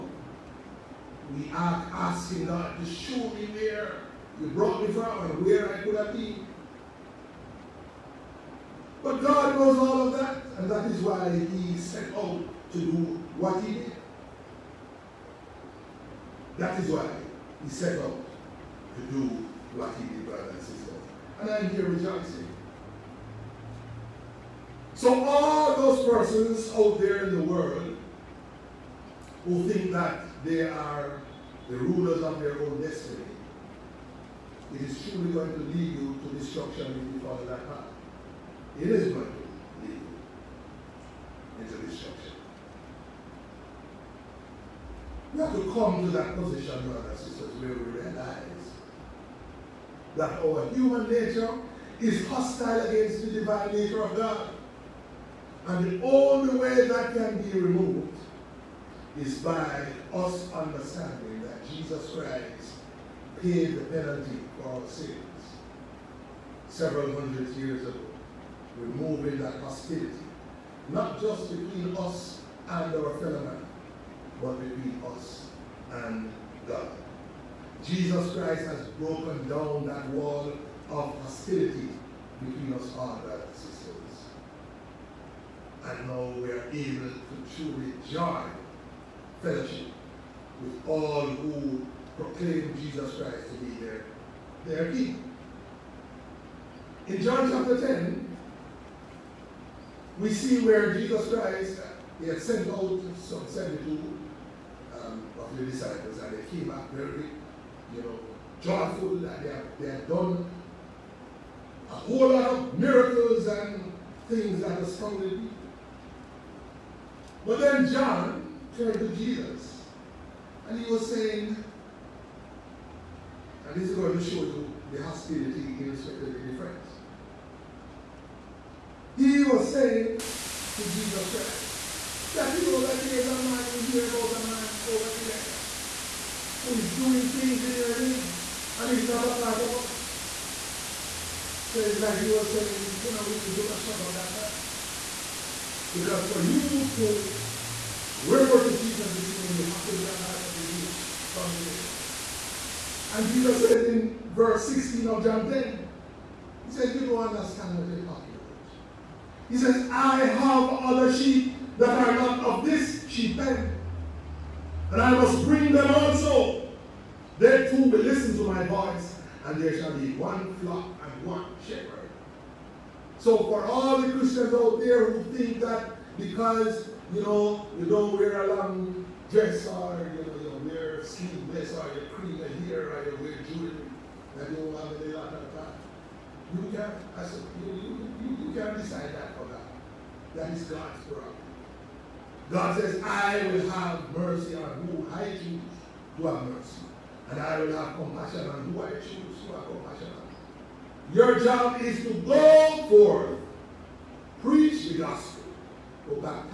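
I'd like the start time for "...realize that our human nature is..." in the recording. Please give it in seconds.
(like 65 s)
47 s.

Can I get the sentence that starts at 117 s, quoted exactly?
But then John turned to Jesus and he was saying, and this is going to show you the hostility against the difference.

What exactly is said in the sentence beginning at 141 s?
So it's like he was saying, you know, we need to shut up that man.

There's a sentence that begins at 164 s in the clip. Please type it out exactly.
And I must bring them also.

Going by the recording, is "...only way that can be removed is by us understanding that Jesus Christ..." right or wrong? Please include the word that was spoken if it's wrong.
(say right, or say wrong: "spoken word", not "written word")
right.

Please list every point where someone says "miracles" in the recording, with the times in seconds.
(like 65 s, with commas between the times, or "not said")
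112 s.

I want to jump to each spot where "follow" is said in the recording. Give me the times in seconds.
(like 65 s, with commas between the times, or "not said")
37 s.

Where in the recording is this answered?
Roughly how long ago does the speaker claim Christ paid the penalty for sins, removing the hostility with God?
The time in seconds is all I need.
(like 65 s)
66 s.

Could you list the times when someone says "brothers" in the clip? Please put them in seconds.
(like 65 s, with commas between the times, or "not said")
20 s, 46 s, 83 s.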